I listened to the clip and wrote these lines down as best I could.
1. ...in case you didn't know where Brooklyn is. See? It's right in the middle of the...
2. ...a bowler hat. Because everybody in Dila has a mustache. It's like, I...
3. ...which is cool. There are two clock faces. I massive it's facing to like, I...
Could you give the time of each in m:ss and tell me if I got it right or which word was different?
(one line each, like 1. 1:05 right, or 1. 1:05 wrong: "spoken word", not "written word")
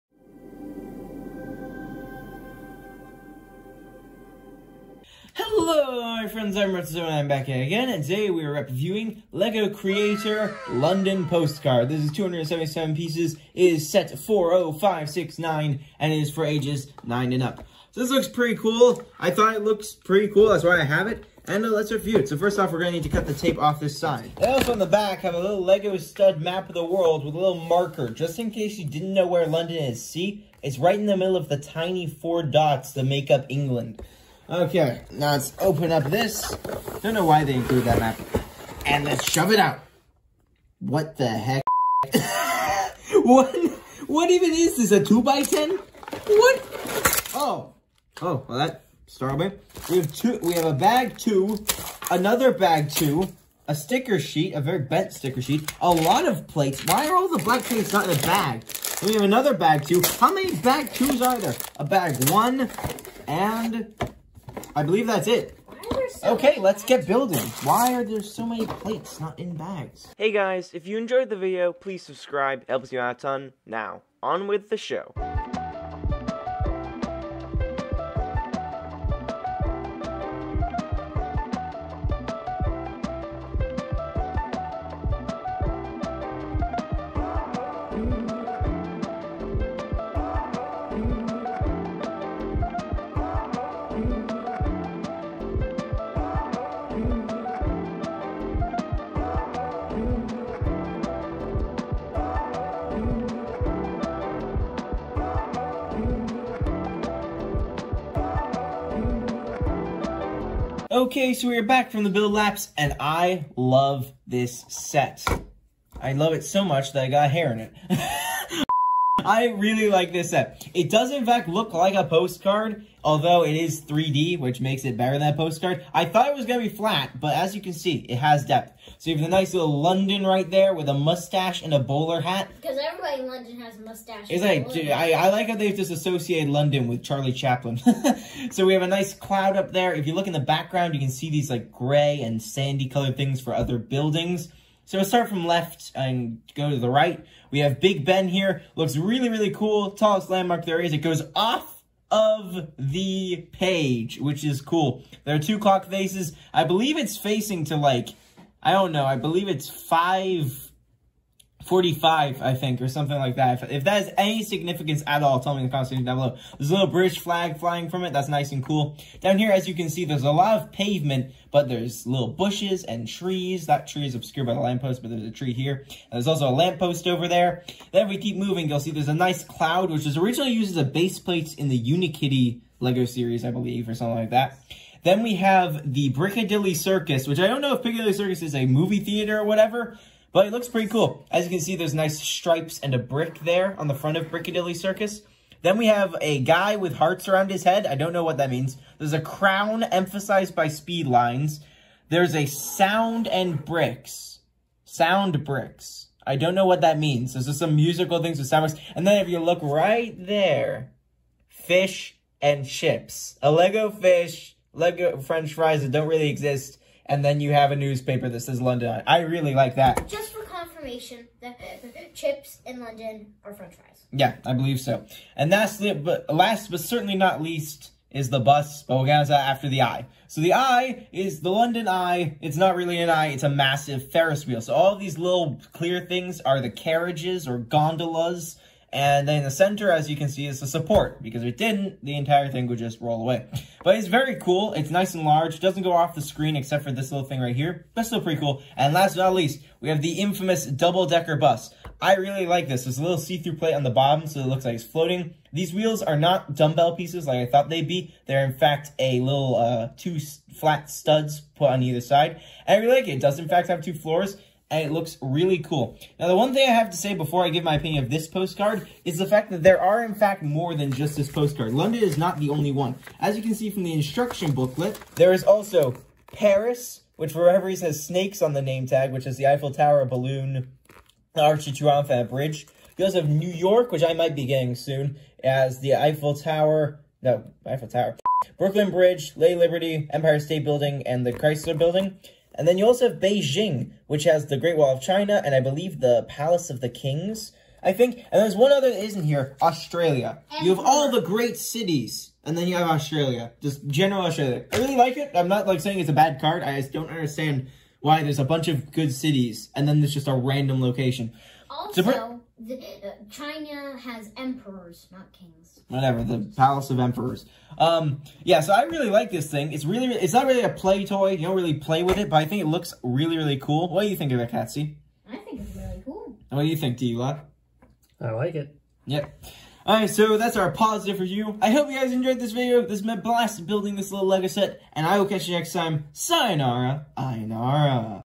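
1. 0:28 wrong: "London", not "Brooklyn"
2. 2:11 wrong: "London", not "Dila"
3. 2:34 wrong: "believe", not "massive".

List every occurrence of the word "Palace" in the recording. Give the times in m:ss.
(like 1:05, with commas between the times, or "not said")
4:56, 5:16.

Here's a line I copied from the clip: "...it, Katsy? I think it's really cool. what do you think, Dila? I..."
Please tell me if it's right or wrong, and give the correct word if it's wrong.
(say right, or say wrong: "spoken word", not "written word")
right.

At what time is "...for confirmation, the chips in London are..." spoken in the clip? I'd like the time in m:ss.
3:40.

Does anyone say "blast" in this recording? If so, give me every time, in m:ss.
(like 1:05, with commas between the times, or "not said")
5:33.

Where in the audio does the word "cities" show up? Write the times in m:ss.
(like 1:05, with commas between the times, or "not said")
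5:01, 5:09.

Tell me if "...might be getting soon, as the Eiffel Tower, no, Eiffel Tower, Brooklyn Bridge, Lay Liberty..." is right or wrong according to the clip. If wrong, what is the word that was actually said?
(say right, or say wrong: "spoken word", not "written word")
right.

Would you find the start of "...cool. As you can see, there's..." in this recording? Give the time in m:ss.
3:10.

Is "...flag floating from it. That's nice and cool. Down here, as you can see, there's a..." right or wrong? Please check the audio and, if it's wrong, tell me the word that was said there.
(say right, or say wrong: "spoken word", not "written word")
wrong: "flying", not "floating".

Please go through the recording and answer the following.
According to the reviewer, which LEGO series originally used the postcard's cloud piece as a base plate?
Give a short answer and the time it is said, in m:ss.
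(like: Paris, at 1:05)
Unikitty, at 3:01.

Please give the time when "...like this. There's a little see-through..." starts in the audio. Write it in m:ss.
4:12.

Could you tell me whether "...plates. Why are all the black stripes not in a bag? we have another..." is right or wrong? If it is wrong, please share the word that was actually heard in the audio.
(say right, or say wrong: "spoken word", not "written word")
wrong: "plates", not "stripes".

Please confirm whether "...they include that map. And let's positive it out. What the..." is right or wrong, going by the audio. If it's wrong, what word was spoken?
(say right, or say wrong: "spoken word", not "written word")
wrong: "shove", not "positive".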